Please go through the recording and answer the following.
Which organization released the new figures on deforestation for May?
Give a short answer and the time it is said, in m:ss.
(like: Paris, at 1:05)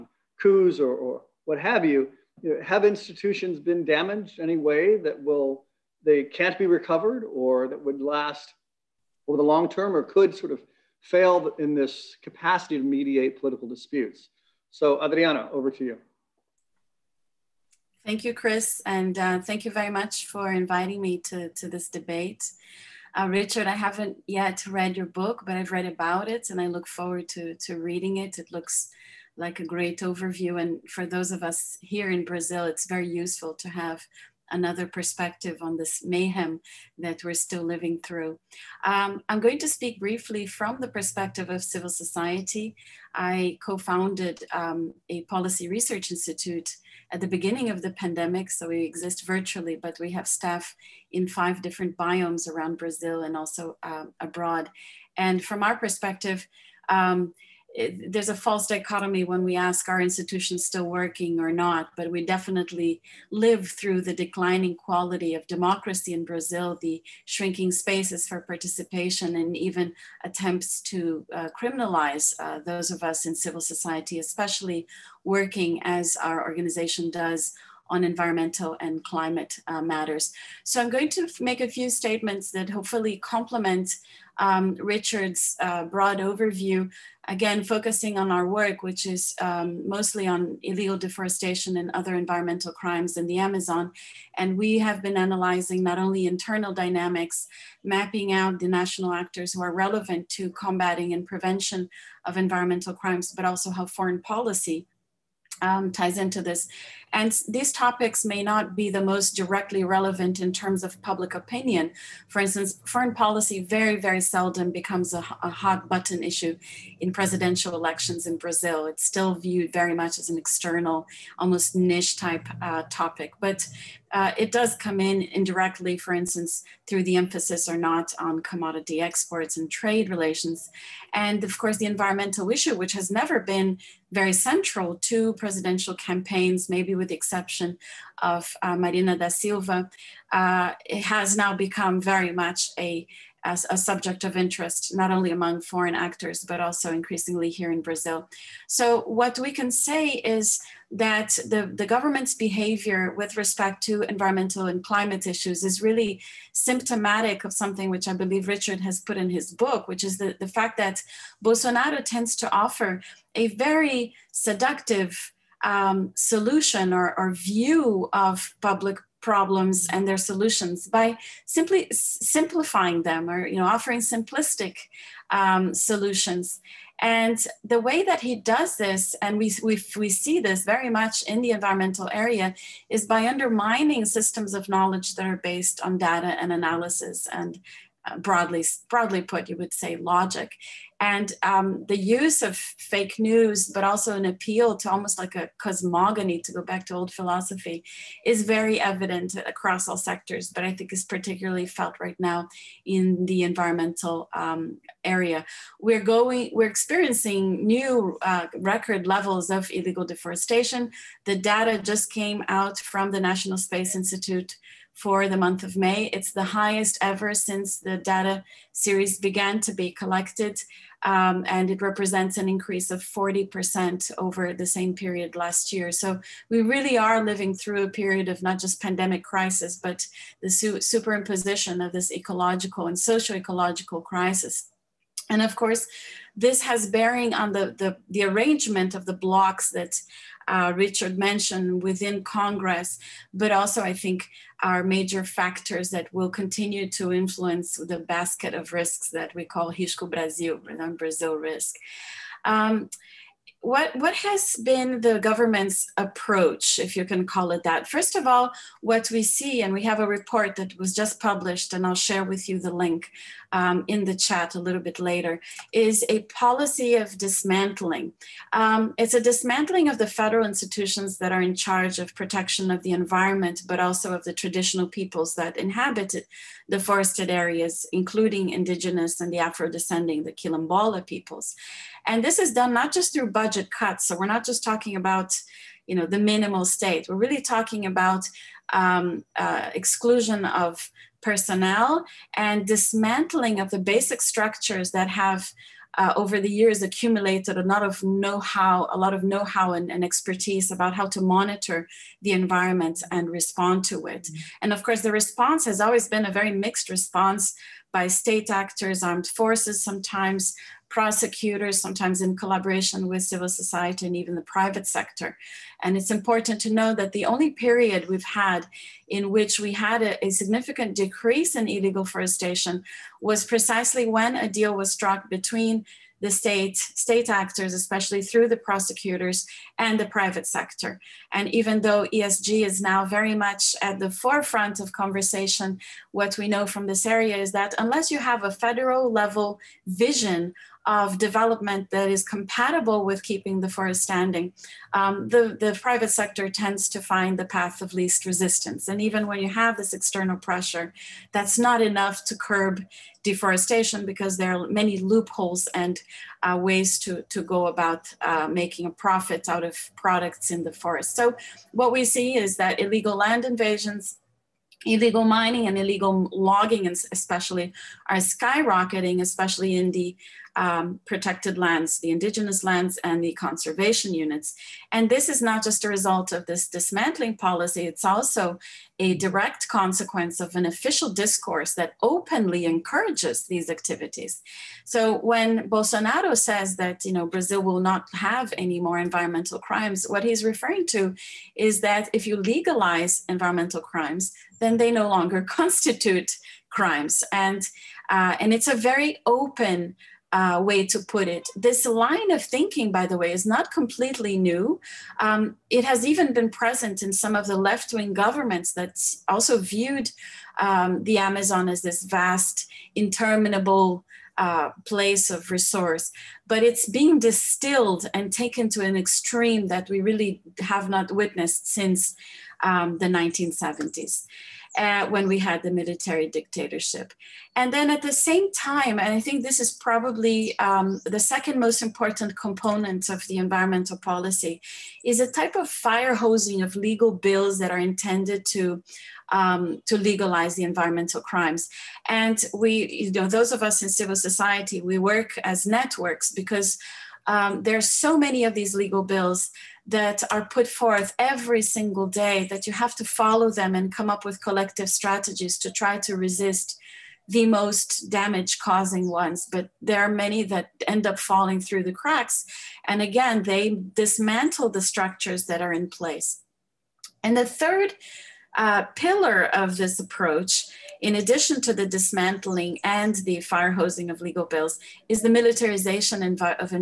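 National Space Institute, at 3:33.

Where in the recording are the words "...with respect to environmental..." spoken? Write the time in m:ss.
2:33.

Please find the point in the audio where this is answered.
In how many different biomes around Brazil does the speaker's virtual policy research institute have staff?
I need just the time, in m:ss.
0:51.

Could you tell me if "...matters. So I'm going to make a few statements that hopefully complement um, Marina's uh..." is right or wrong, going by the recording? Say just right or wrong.
wrong.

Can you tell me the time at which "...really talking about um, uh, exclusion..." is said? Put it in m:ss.
4:47.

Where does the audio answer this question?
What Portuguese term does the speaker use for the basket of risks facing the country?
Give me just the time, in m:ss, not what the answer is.
4:09.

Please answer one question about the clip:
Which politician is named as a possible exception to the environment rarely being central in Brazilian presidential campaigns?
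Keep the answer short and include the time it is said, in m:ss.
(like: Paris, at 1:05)
Marina da Silva, at 2:18.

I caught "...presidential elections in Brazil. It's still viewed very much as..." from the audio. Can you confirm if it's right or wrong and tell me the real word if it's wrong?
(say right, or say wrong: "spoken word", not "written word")
right.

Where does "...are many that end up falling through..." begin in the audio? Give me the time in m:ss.
7:40.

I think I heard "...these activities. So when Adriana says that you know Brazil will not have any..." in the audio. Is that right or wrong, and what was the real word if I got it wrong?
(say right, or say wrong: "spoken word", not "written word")
wrong: "Bolsonaro", not "Adriana".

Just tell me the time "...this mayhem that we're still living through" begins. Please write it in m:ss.
0:35.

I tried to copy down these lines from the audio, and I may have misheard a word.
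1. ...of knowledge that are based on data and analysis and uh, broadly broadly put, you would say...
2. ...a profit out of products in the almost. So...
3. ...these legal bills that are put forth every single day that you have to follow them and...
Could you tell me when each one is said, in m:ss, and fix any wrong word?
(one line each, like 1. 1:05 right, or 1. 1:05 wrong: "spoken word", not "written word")
1. 3:04 right
2. 5:58 wrong: "forest", not "almost"
3. 7:28 right.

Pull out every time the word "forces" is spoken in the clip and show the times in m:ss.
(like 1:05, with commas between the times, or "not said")
5:09.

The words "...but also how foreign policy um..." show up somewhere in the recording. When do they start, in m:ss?
1:43.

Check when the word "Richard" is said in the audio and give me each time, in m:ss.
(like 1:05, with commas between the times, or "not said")
0:23, 1:24, 2:38, 4:00.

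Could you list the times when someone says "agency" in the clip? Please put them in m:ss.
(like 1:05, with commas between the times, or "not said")
not said.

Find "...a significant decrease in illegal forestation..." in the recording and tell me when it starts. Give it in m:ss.
5:20.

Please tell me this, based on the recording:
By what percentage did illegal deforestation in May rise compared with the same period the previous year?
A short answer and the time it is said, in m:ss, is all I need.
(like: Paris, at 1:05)
40%, at 3:43.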